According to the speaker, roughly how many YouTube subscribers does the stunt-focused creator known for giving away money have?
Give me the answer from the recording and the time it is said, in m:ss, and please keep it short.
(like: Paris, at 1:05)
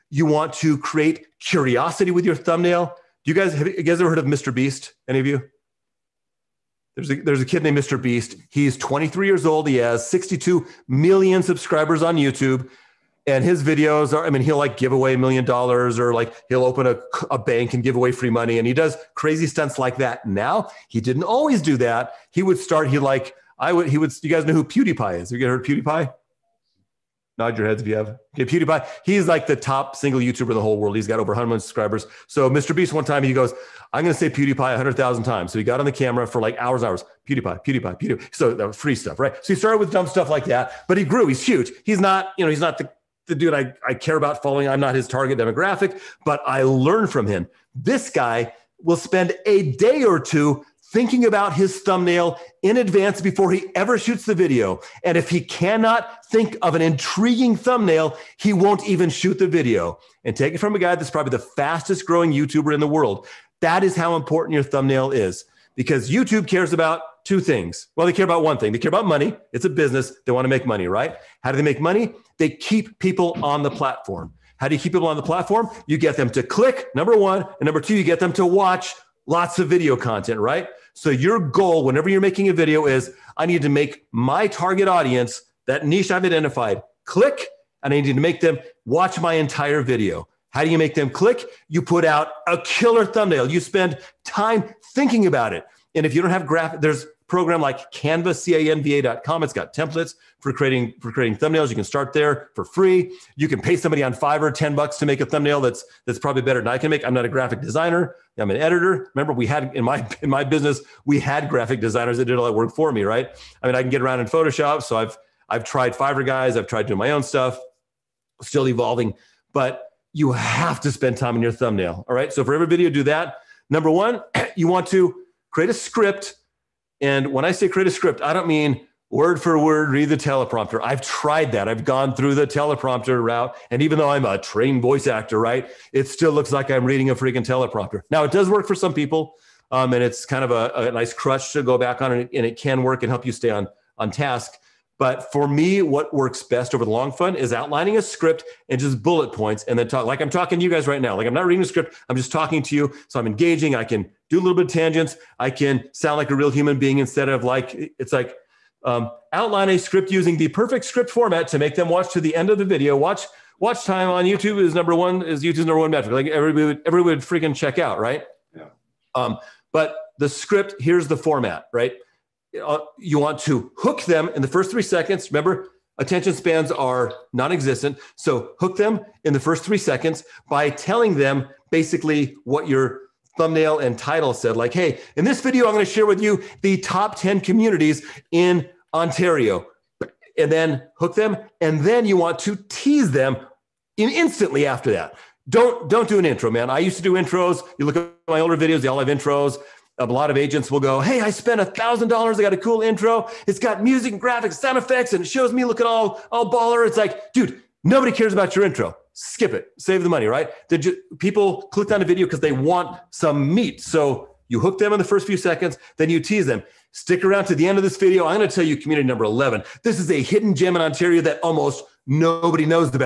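62 million, at 0:10.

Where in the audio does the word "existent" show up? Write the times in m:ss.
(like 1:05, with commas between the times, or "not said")
2:57.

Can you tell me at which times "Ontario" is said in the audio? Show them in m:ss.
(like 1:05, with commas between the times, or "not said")
3:08, 3:40.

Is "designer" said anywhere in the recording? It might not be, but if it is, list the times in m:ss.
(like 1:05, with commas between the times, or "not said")
1:47, 1:51.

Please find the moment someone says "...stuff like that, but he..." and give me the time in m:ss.
0:40.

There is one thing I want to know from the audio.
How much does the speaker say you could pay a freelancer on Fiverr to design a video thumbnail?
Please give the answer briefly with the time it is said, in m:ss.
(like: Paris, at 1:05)
10 bucks, at 1:44.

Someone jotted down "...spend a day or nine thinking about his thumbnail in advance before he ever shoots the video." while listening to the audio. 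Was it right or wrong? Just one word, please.
wrong.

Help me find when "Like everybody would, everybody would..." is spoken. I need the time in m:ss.
2:46.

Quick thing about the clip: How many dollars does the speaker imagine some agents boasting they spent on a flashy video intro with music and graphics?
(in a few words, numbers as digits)
1,000 dollars.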